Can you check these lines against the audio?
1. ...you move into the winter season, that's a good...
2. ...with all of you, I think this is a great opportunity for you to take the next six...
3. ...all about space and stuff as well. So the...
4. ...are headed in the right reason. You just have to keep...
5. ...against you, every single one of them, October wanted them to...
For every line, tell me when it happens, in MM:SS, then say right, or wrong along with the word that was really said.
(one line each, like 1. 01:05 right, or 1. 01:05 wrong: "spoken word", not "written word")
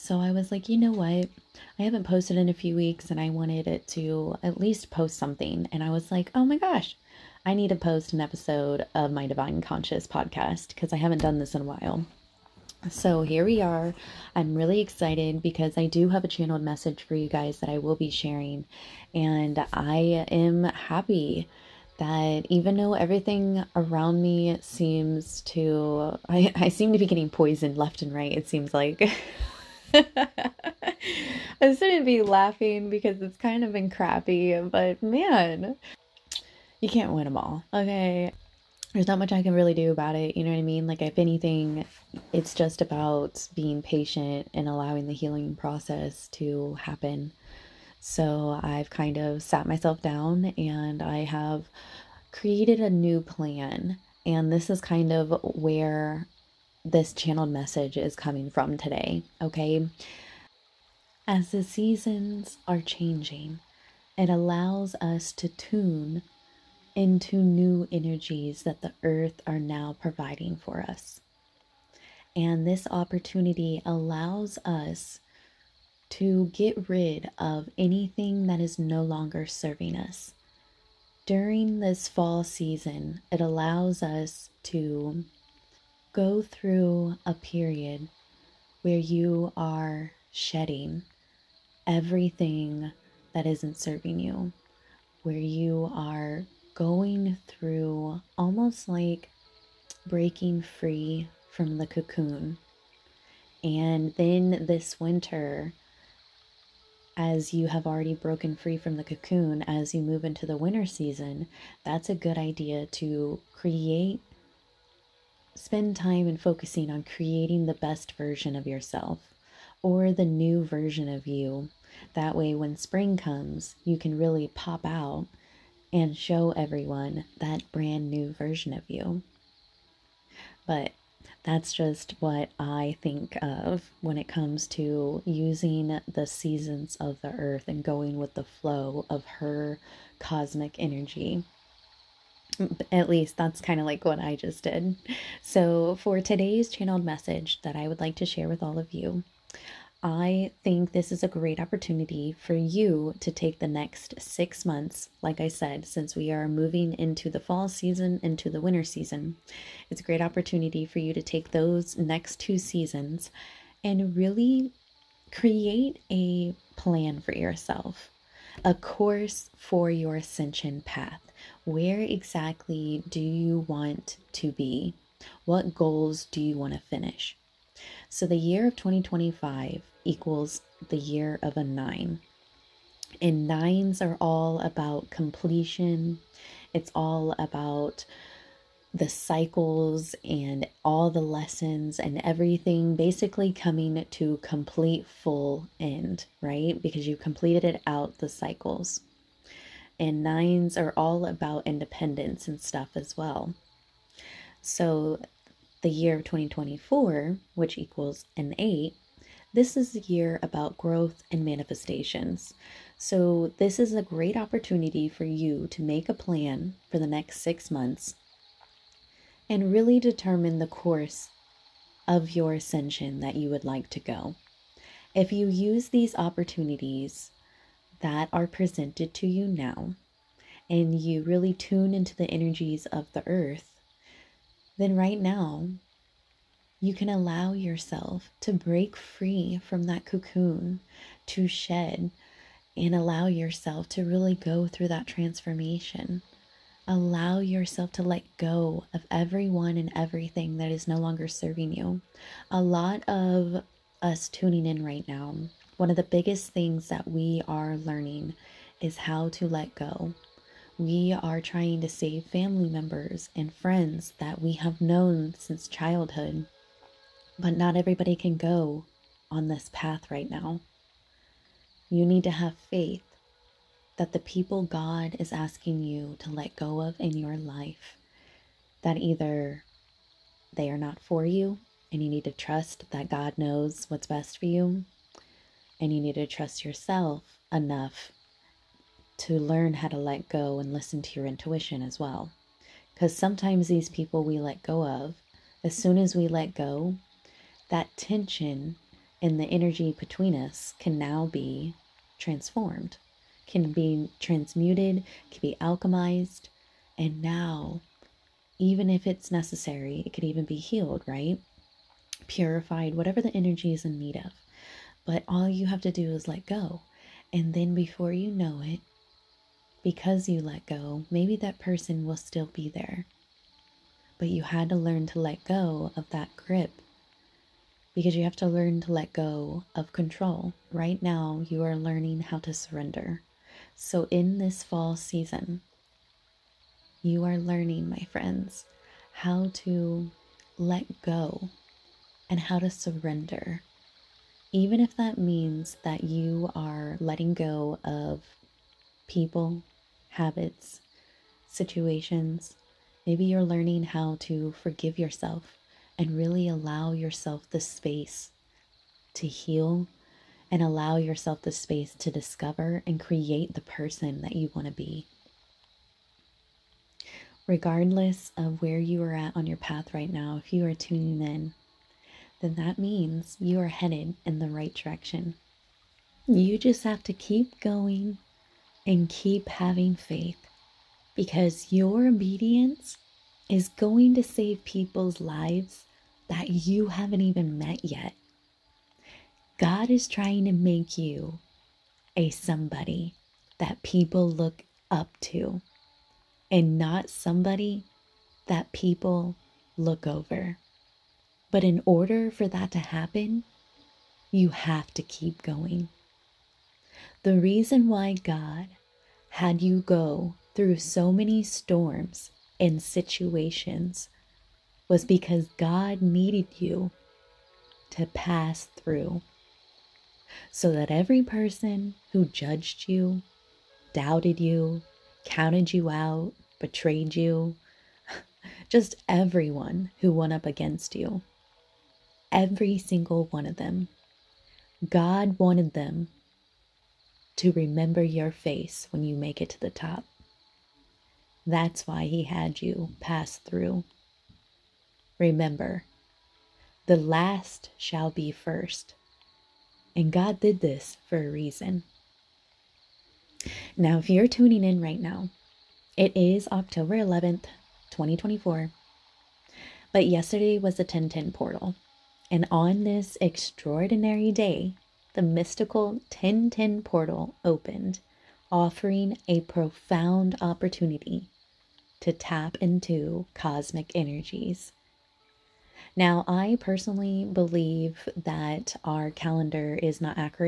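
1. 01:49 right
2. 02:28 right
3. 03:20 wrong: "independence", not "space"
4. 06:13 wrong: "direction", not "reason"
5. 07:10 wrong: "God", not "October".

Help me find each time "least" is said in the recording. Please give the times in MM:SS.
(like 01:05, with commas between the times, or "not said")
00:04, 02:23.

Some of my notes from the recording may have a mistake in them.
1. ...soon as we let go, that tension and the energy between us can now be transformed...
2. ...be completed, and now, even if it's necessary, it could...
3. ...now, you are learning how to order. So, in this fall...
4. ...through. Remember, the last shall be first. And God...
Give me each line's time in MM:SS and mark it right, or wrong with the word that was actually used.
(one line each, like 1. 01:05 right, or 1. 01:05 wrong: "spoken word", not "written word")
1. 04:55 right
2. 05:05 wrong: "alchemized", not "completed"
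3. 05:31 wrong: "surrender", not "order"
4. 07:23 right.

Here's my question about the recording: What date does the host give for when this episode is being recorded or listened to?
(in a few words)
October 11th, 2024.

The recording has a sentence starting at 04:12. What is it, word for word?
A lot of us tuning in right now, one of the biggest things that we are learning is how to let go.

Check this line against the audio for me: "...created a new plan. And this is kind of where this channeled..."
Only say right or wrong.
right.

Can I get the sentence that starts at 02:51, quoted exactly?
Where exactly do you want to be?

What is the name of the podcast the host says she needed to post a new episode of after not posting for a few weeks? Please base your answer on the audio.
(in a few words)
Divine Conscious.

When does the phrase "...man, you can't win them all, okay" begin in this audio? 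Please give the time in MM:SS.
00:35.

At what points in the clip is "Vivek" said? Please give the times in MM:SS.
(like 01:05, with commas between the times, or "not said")
not said.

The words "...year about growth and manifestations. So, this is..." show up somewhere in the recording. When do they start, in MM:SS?
03:29.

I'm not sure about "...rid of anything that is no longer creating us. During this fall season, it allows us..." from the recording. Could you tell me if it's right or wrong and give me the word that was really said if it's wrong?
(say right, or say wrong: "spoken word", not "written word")
wrong: "serving", not "creating".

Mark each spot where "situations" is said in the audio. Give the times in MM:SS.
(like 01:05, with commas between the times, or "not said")
05:51, 06:52.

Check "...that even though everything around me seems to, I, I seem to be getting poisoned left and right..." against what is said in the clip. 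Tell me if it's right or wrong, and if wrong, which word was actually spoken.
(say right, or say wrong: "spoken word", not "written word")
right.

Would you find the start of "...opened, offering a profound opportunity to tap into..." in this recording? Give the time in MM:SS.
07:47.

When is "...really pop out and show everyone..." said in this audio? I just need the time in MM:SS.
02:04.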